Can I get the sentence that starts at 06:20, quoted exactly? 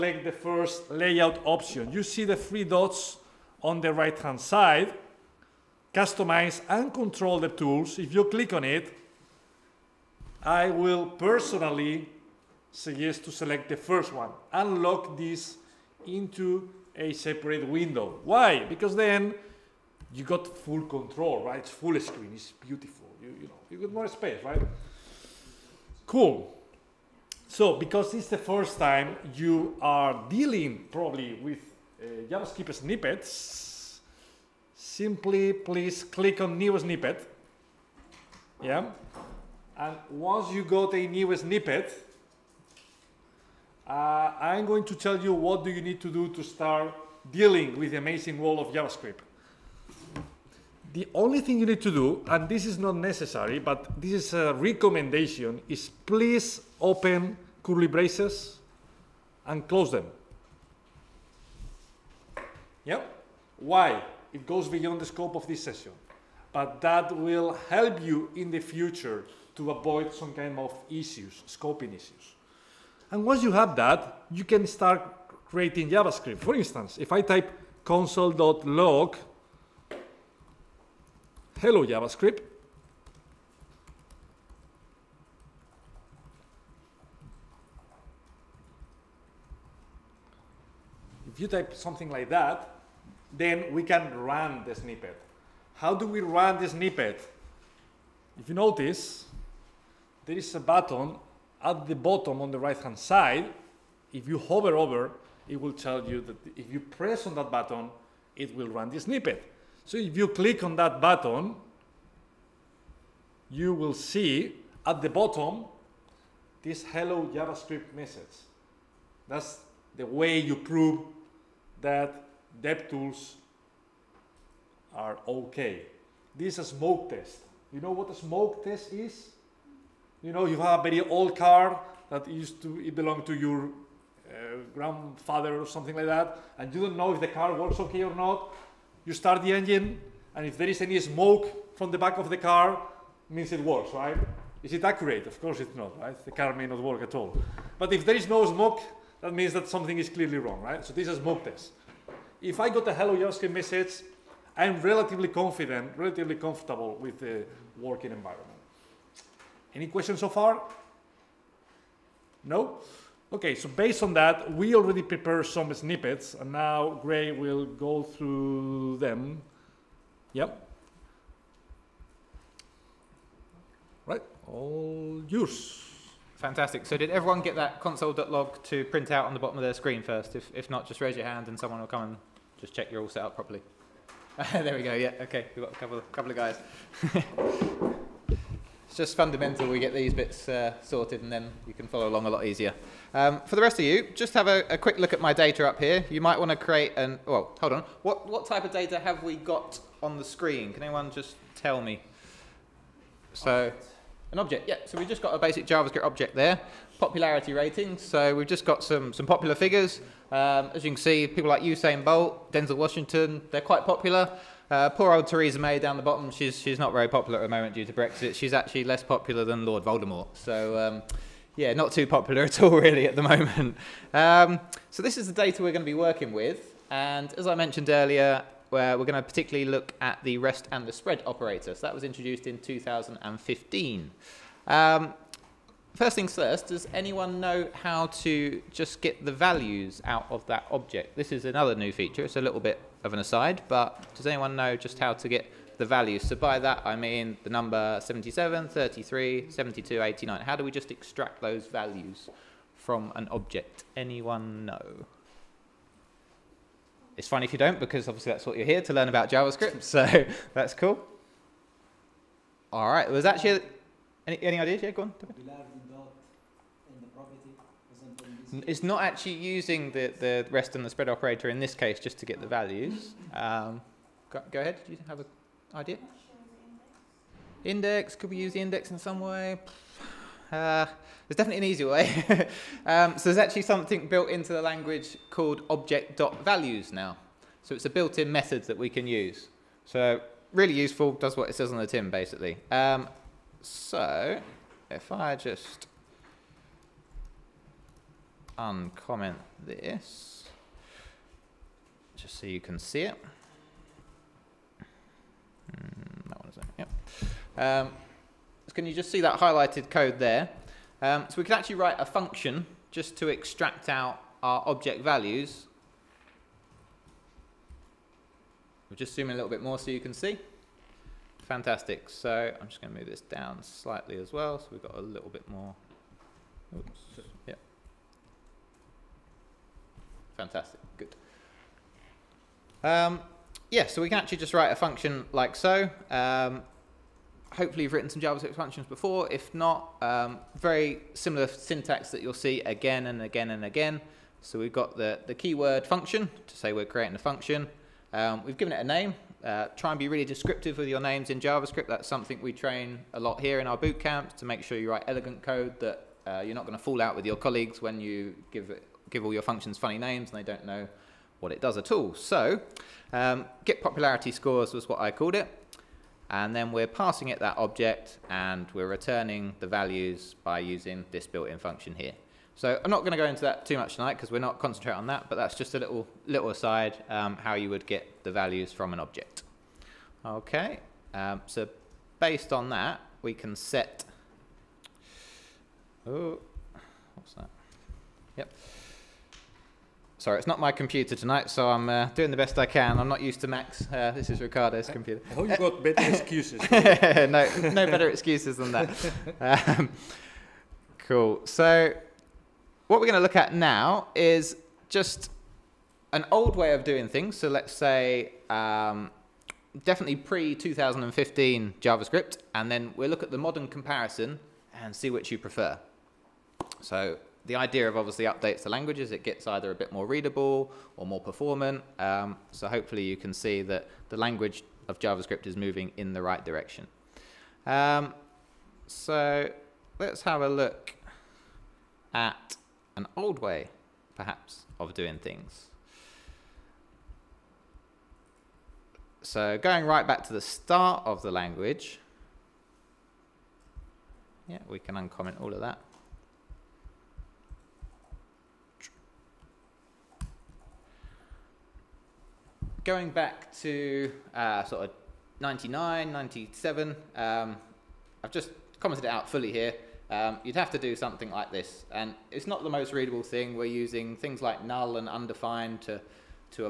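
Okay, um, so based on that, we can set, oh, what's that?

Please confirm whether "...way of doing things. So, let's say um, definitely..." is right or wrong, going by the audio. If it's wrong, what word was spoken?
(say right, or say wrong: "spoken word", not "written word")
right.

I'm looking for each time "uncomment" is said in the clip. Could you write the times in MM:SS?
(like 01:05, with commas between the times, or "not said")
04:58, 07:24.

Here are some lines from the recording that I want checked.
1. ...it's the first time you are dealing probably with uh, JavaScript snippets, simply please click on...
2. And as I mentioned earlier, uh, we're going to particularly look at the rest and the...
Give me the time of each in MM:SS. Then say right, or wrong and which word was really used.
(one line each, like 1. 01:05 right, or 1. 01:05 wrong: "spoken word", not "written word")
1. 00:28 right
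2. 03:46 right.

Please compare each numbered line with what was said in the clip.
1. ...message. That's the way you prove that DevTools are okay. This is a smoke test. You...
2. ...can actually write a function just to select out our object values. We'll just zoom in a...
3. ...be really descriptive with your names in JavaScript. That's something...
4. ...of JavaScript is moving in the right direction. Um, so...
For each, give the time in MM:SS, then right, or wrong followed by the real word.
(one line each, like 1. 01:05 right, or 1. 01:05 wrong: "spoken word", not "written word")
1. 01:57 right
2. 05:11 wrong: "extract", not "select"
3. 05:49 right
4. 07:04 right.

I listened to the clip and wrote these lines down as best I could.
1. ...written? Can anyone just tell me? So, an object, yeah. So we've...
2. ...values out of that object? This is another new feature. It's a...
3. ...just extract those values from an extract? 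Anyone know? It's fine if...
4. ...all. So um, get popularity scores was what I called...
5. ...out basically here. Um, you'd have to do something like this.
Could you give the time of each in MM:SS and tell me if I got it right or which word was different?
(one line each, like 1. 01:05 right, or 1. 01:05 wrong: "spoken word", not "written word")
1. 03:20 wrong: "screen", not "written"
2. 03:59 right
3. 04:10 wrong: "object", not "extract"
4. 06:01 right
5. 07:39 wrong: "fully", not "basically".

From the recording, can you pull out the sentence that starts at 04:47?
So it's a built-in method that we can use.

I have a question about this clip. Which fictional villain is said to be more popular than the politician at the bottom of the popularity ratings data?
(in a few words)
Lord Voldemort.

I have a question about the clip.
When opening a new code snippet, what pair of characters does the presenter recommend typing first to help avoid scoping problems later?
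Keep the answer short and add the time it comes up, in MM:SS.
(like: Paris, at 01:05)
curly braces, at 00:57.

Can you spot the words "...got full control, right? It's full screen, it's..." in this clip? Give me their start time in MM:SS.
00:20.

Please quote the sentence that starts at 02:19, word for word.
You start the engine, and if there is any smoke from the back of the car, means it works, right?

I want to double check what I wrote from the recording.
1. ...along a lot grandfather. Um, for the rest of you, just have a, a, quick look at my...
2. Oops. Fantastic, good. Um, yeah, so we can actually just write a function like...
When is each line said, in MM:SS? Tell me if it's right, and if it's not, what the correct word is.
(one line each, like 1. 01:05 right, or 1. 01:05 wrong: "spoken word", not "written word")
1. 03:12 wrong: "easier", not "grandfather"
2. 05:26 right.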